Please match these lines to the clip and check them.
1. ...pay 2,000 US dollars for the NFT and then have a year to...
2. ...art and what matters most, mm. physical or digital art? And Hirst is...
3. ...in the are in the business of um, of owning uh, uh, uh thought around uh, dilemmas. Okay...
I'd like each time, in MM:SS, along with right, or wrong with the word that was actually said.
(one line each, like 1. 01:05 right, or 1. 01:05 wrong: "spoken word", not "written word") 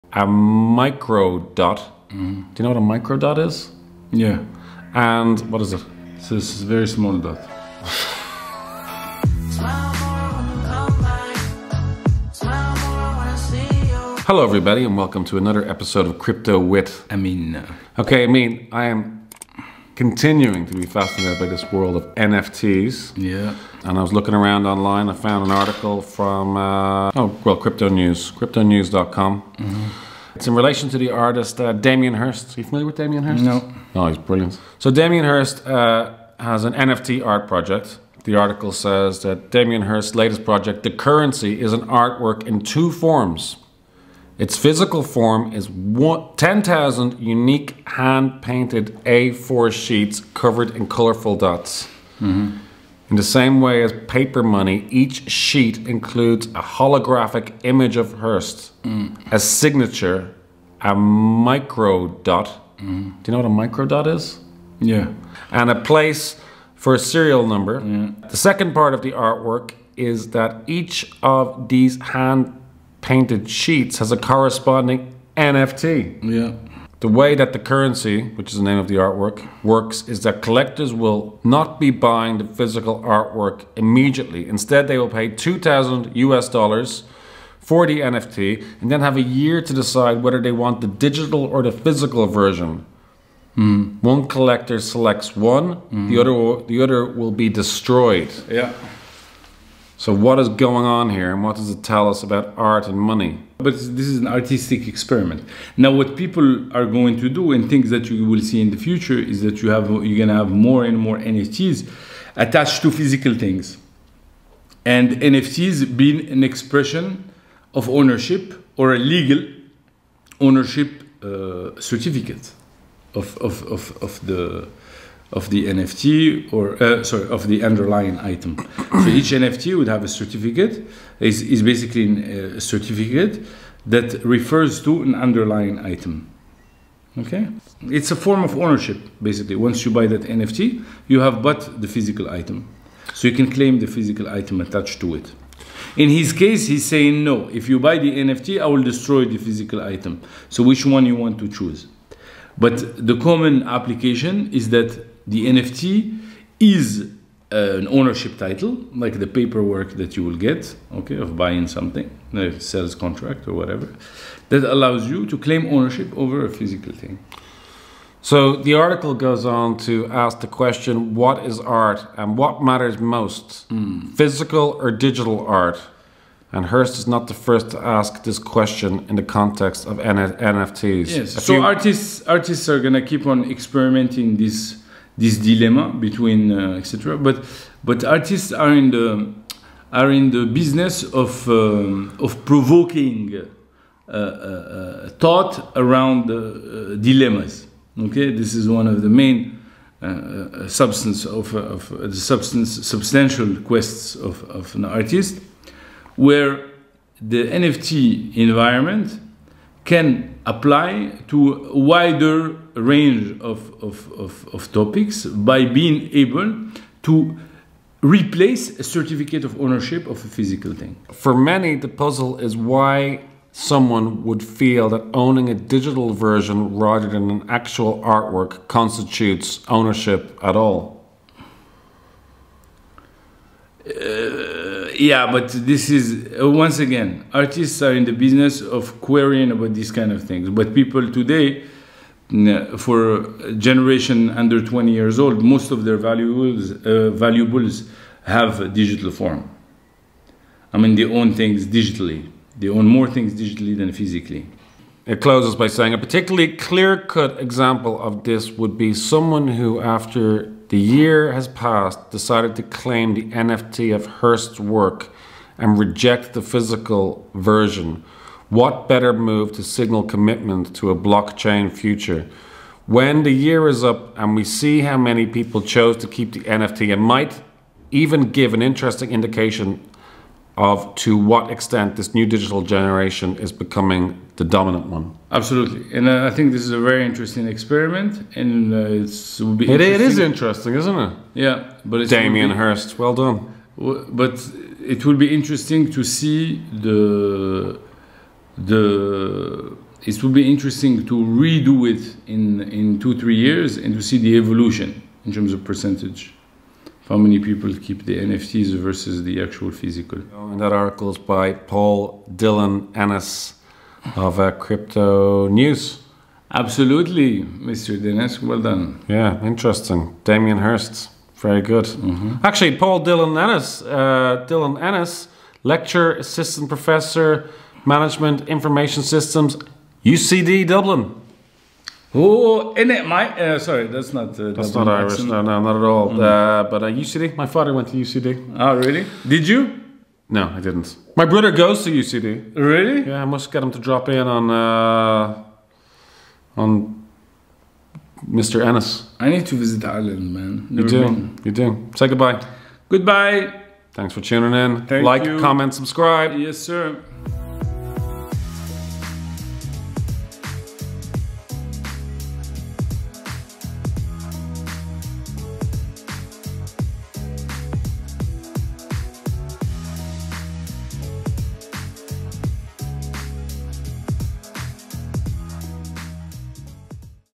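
1. 01:25 right
2. 02:51 right
3. 03:08 wrong: "provoking", not "owning".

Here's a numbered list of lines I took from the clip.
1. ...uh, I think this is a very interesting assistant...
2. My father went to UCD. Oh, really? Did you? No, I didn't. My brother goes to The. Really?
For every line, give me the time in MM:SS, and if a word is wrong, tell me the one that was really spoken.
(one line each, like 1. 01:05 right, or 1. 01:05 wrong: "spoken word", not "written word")
1. 04:46 wrong: "experiment", not "assistant"
2. 05:37 wrong: "UCD", not "The".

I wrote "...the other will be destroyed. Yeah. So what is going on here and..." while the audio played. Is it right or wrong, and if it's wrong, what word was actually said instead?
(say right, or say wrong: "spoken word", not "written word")
right.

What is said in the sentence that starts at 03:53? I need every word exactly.
Uh, yeah, but this is uh, once again, artists are in the business of querying about these kind of things.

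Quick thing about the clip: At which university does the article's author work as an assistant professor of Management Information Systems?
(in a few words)
UCD Dublin.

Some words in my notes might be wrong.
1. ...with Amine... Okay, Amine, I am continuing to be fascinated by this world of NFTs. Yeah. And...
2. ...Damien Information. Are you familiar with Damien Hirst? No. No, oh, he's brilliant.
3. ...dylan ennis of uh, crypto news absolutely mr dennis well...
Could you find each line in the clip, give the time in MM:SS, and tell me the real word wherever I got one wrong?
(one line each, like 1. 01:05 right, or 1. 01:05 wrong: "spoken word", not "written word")
1. 00:16 right
2. 00:31 wrong: "Hirst", not "Information"
3. 05:12 right.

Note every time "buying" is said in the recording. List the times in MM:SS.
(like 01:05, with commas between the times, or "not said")
01:22, 02:41.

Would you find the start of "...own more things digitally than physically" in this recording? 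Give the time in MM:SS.
04:12.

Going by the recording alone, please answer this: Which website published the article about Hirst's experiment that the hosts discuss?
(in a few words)
cryptonews.com.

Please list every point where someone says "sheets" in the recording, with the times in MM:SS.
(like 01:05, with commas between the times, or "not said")
00:49, 00:55, 01:13.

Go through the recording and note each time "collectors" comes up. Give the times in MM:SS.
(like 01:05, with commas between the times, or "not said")
01:20, 01:34.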